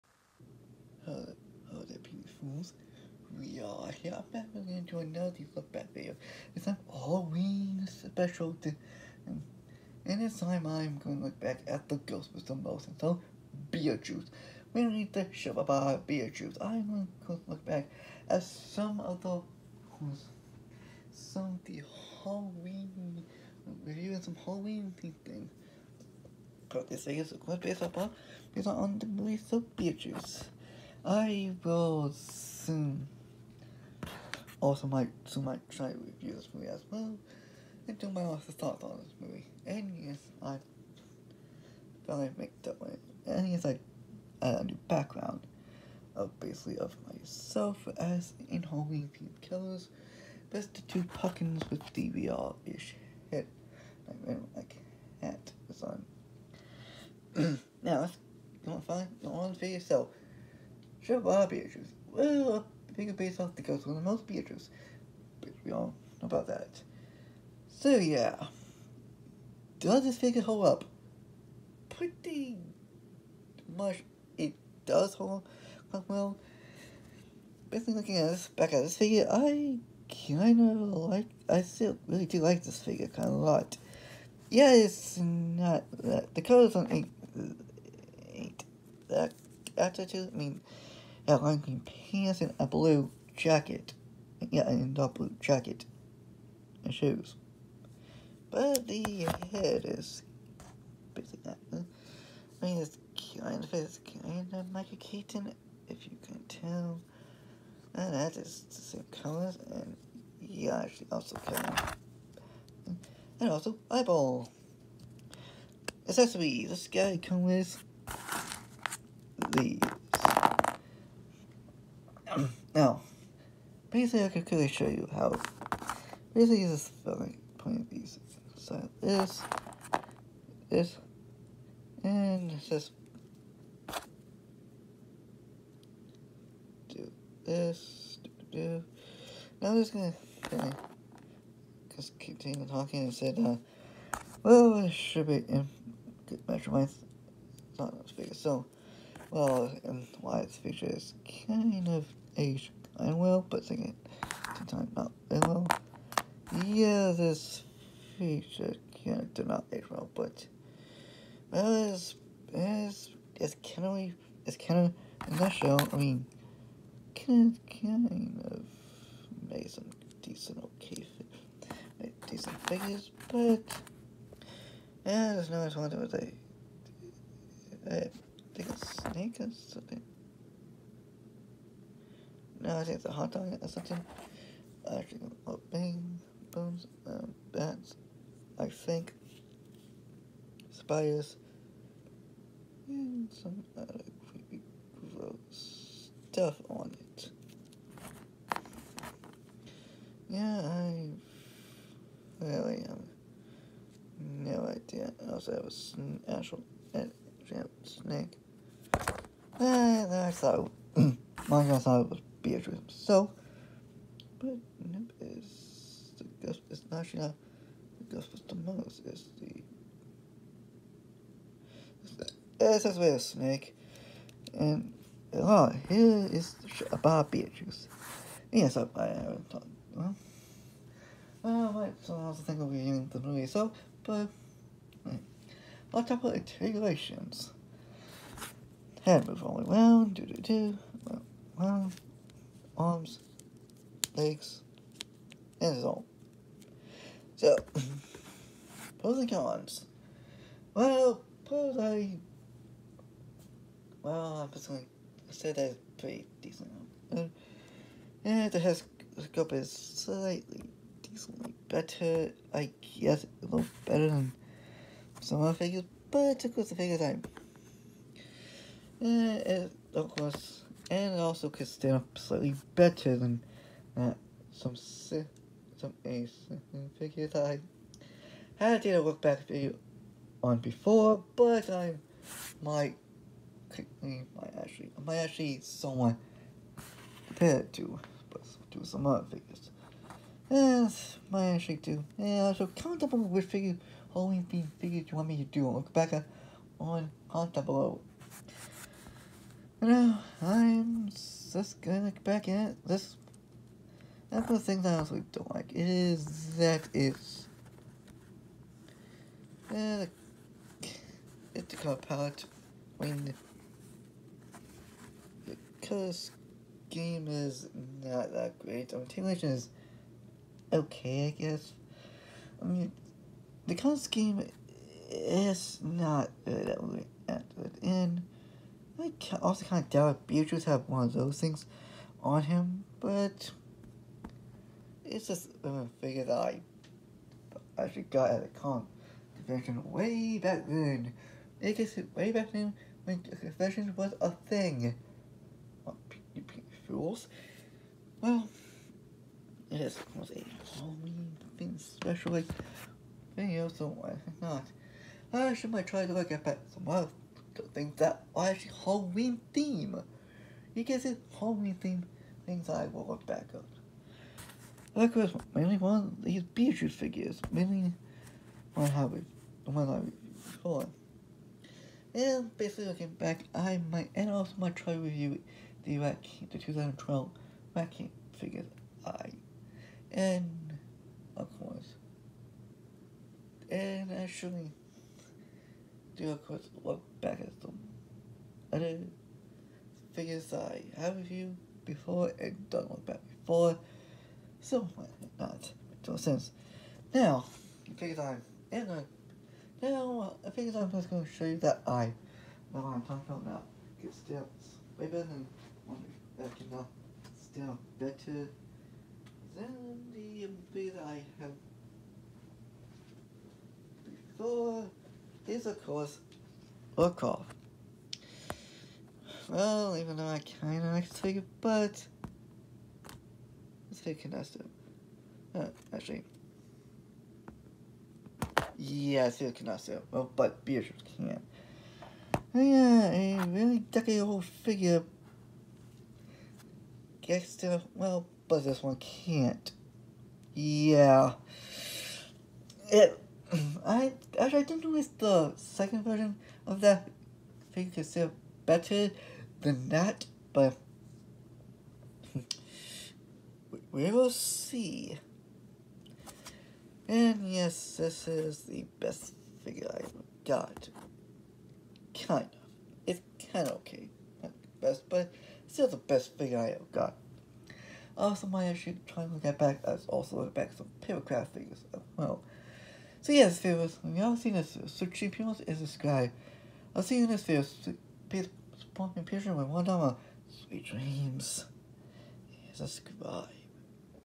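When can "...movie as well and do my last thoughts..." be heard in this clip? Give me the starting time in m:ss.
0:36.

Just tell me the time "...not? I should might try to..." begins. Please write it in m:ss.
5:54.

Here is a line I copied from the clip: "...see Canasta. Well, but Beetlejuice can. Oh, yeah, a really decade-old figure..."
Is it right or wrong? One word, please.
right.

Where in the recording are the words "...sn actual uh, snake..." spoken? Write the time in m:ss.
3:25.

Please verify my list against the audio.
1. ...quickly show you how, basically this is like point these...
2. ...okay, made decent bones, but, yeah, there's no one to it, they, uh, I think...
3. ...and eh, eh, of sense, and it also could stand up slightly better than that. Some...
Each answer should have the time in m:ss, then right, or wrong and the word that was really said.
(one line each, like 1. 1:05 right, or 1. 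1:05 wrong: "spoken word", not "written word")
1. 2:04 right
2. 2:50 wrong: "figures", not "bones"
3. 4:29 wrong: "course", not "sense".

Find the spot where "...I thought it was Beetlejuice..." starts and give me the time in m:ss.
3:31.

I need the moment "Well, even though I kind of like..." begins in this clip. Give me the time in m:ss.
6:59.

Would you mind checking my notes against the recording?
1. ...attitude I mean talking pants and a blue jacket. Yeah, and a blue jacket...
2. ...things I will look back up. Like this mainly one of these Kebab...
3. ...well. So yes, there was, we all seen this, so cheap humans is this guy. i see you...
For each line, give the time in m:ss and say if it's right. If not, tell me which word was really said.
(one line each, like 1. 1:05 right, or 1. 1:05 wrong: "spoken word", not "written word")
1. 1:29 wrong: "outlining", not "talking"
2. 6:02 wrong: "Beetlejuice", not "Kebab"
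3. 7:52 right.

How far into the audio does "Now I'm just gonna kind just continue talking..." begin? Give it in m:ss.
2:19.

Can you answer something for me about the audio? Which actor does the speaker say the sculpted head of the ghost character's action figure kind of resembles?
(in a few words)
Michael Keaton.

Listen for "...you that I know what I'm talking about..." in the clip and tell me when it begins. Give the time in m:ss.
6:41.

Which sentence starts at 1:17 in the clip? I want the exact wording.
Basically looking at this back at this figure, I kinda like I still really do like this figure kinda a lot.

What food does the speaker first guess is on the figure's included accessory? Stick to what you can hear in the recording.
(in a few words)
hot dog.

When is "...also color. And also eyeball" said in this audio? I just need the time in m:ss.
1:51.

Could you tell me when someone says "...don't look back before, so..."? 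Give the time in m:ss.
6:32.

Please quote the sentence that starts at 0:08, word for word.
To, um, and, this time I'm going to look back at the ghost with the most.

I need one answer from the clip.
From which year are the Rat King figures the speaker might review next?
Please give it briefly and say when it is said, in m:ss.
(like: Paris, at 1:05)
2012, at 6:16.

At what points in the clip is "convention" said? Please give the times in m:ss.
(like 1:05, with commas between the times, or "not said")
5:39, 5:43.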